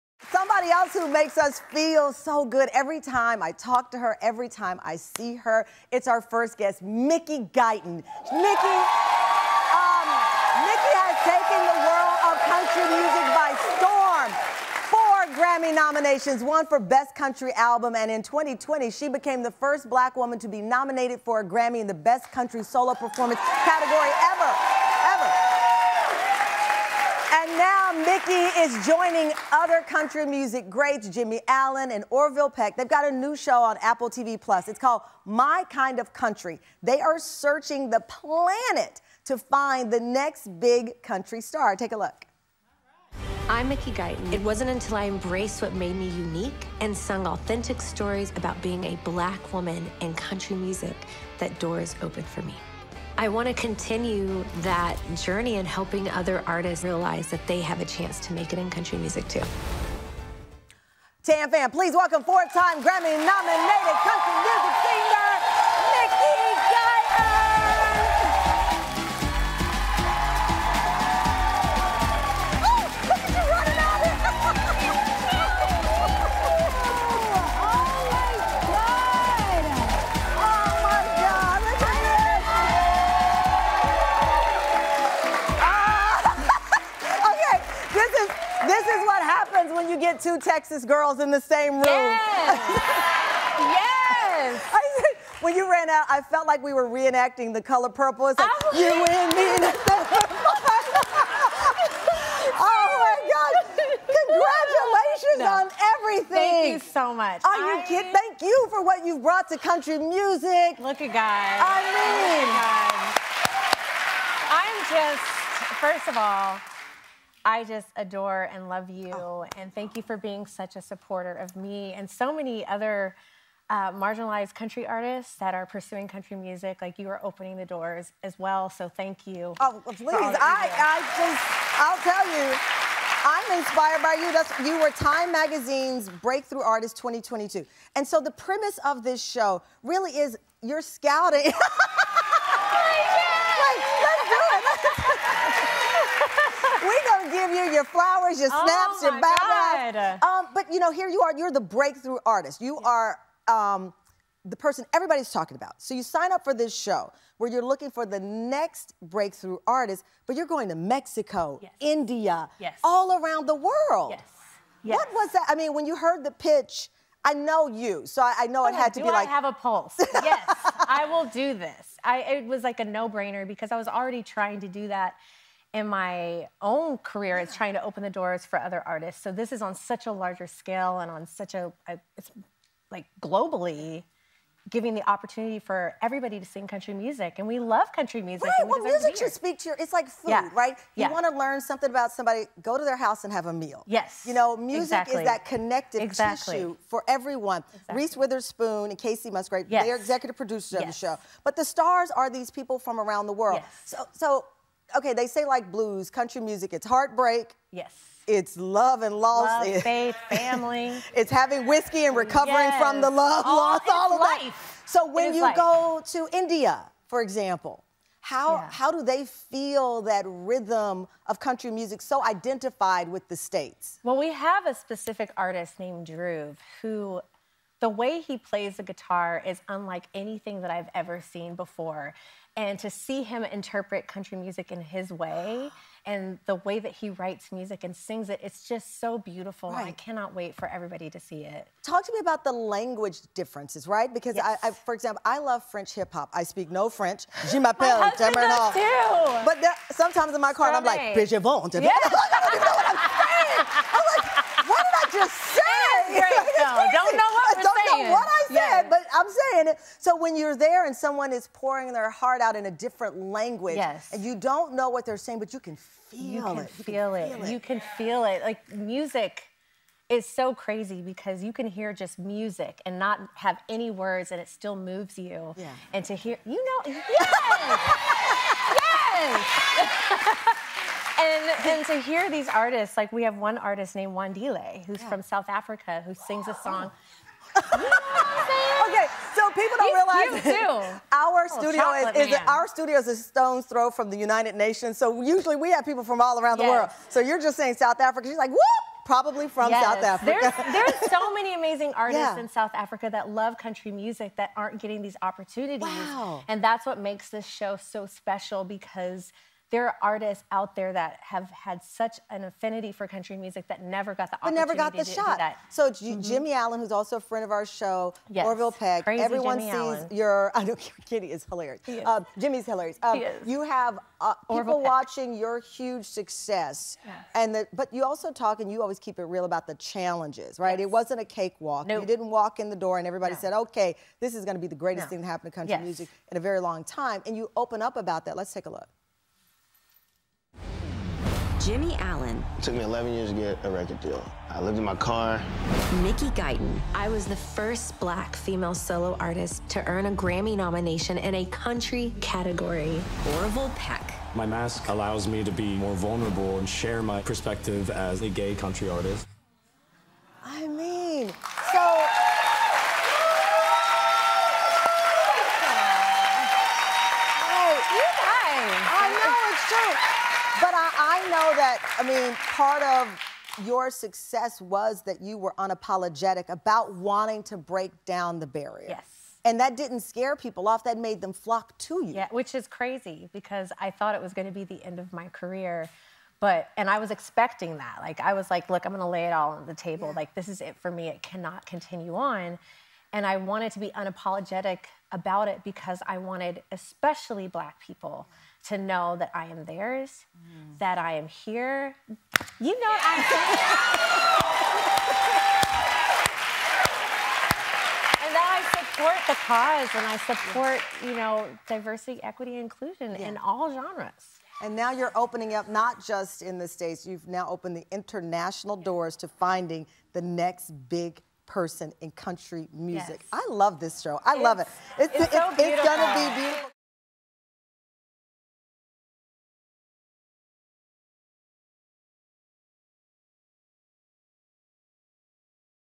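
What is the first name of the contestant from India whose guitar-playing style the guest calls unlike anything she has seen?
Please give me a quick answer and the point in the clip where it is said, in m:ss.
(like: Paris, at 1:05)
Drew, at 3:46.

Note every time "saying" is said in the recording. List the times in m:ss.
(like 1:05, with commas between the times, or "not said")
4:13, 4:19, 4:25, 4:57.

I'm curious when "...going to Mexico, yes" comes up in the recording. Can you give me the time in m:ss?
2:40.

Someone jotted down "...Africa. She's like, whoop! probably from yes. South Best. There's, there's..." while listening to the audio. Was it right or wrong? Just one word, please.
wrong.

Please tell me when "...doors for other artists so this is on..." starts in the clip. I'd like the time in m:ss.
2:58.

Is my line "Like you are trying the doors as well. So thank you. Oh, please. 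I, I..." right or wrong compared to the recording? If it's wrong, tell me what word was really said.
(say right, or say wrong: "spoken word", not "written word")
wrong: "opening", not "trying".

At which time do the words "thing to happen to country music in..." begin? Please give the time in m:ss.
5:35.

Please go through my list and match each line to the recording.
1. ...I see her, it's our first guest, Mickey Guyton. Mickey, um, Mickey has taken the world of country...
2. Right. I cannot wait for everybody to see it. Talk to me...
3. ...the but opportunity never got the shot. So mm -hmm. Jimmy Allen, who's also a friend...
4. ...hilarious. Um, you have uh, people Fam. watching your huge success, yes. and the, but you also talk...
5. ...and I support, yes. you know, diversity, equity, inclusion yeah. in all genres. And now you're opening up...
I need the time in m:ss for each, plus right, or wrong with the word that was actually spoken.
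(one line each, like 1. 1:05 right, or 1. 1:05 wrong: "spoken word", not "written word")
1. 0:04 right
2. 3:59 right
3. 5:14 right
4. 5:22 wrong: "Peck", not "Fam"
5. 6:49 right.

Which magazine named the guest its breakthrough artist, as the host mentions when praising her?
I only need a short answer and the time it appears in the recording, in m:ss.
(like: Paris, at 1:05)
Time Magazine, at 2:14.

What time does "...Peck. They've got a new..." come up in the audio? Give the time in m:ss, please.
0:32.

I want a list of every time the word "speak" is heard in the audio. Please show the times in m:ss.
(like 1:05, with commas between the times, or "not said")
3:09, 4:06.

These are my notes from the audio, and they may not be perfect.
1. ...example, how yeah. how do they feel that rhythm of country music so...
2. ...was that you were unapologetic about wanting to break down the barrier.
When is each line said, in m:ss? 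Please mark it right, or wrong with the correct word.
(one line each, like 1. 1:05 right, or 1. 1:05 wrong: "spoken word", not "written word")
1. 3:37 right
2. 6:14 right.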